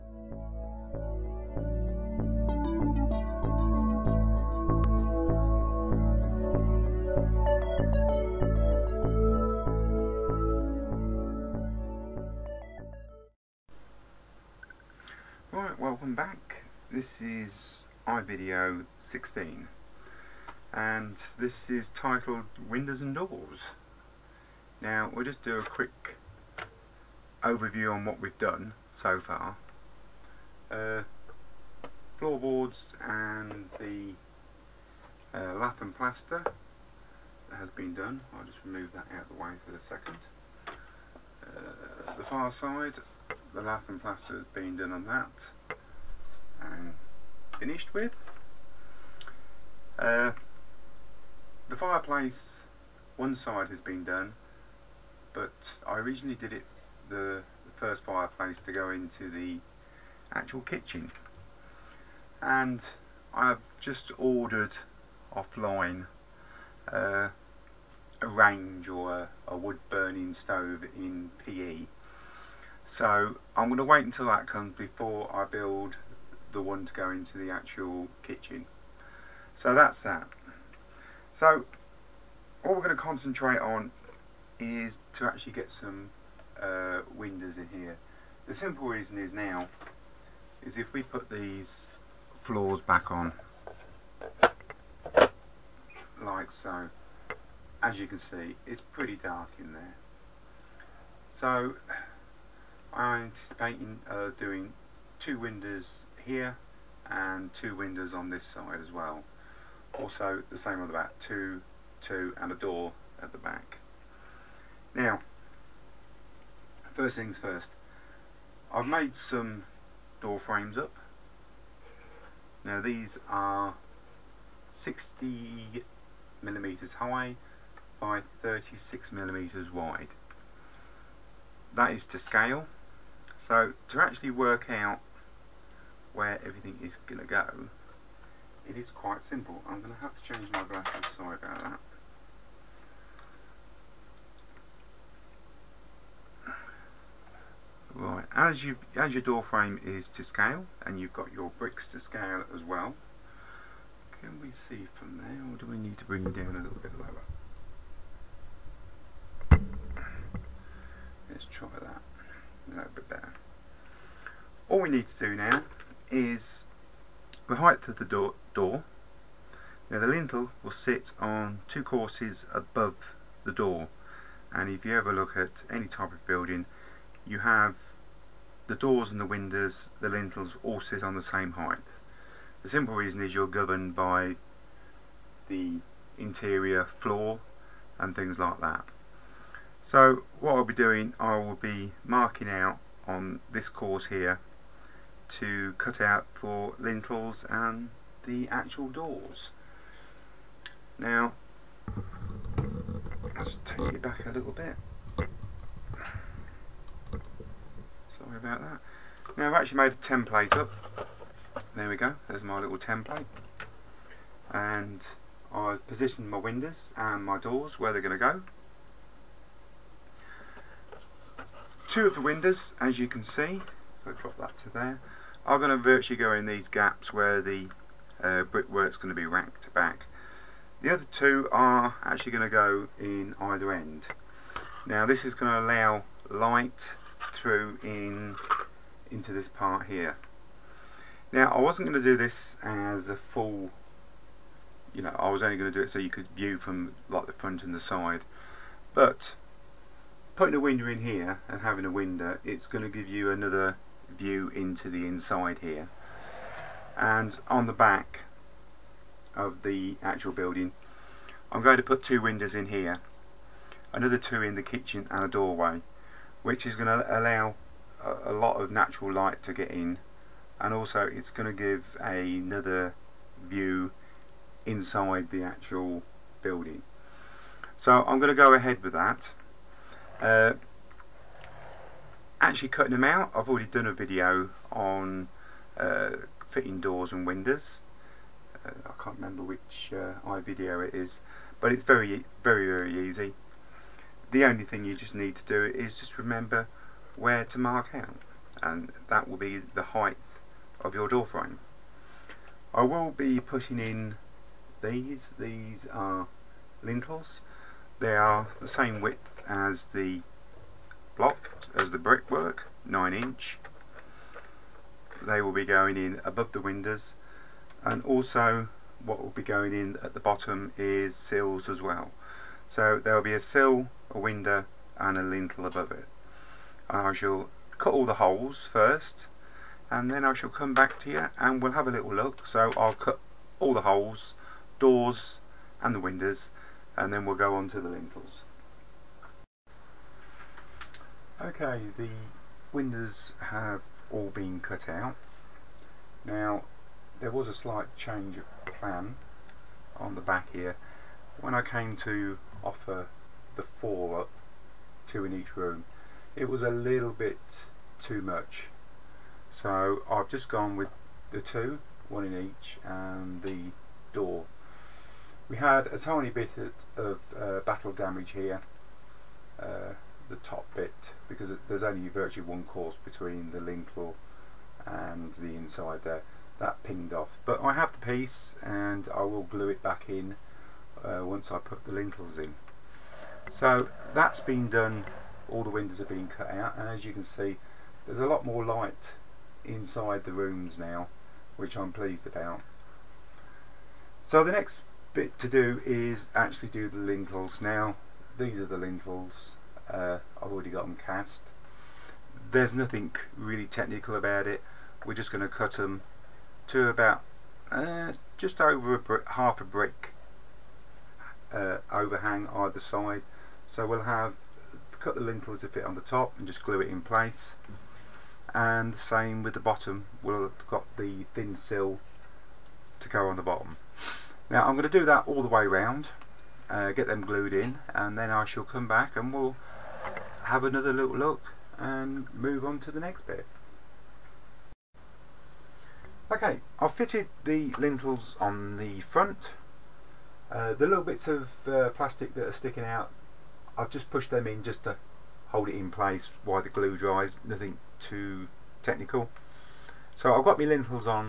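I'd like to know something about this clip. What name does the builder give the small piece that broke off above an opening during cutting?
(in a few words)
battle damage.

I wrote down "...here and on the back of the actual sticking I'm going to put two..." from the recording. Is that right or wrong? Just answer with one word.
wrong.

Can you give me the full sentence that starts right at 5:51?
When I came to offer the four up, two in each room, it was a little bit too much.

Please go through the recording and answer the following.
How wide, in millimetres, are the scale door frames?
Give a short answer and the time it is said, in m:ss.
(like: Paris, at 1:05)
36 millimeters, at 2:08.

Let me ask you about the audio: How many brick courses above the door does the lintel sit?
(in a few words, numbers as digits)
2.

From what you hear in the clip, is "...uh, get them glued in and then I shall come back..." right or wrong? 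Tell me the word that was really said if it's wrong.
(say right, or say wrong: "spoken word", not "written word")
right.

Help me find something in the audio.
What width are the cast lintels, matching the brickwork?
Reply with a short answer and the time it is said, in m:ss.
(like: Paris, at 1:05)
9 inch, at 5:12.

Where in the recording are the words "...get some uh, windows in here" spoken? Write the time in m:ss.
1:25.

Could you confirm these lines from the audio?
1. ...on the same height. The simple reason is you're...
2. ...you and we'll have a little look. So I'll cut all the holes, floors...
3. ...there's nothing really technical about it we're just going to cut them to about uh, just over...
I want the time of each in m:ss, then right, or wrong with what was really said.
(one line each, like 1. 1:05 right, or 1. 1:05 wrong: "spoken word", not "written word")
1. 3:01 right
2. 5:31 wrong: "doors", not "floors"
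3. 6:42 right.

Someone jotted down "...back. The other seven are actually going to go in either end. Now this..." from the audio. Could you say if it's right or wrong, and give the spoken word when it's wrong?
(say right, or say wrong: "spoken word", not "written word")
wrong: "two", not "seven".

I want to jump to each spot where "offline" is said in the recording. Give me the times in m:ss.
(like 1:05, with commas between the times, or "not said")
1:05.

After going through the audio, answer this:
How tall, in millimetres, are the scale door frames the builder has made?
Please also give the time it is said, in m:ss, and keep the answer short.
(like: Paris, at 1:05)
60 millimeters, at 2:04.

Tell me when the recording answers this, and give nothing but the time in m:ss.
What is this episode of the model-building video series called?
0:22.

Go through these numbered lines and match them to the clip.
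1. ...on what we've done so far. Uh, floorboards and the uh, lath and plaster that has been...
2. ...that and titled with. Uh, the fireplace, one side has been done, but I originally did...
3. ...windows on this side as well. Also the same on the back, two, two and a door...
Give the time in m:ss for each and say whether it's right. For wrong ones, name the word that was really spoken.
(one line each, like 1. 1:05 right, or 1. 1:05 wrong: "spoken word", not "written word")
1. 0:27 right
2. 0:45 wrong: "finished", not "titled"
3. 1:47 right.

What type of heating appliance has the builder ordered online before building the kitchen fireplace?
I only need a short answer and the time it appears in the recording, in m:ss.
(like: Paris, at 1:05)
wood burning stove, at 1:09.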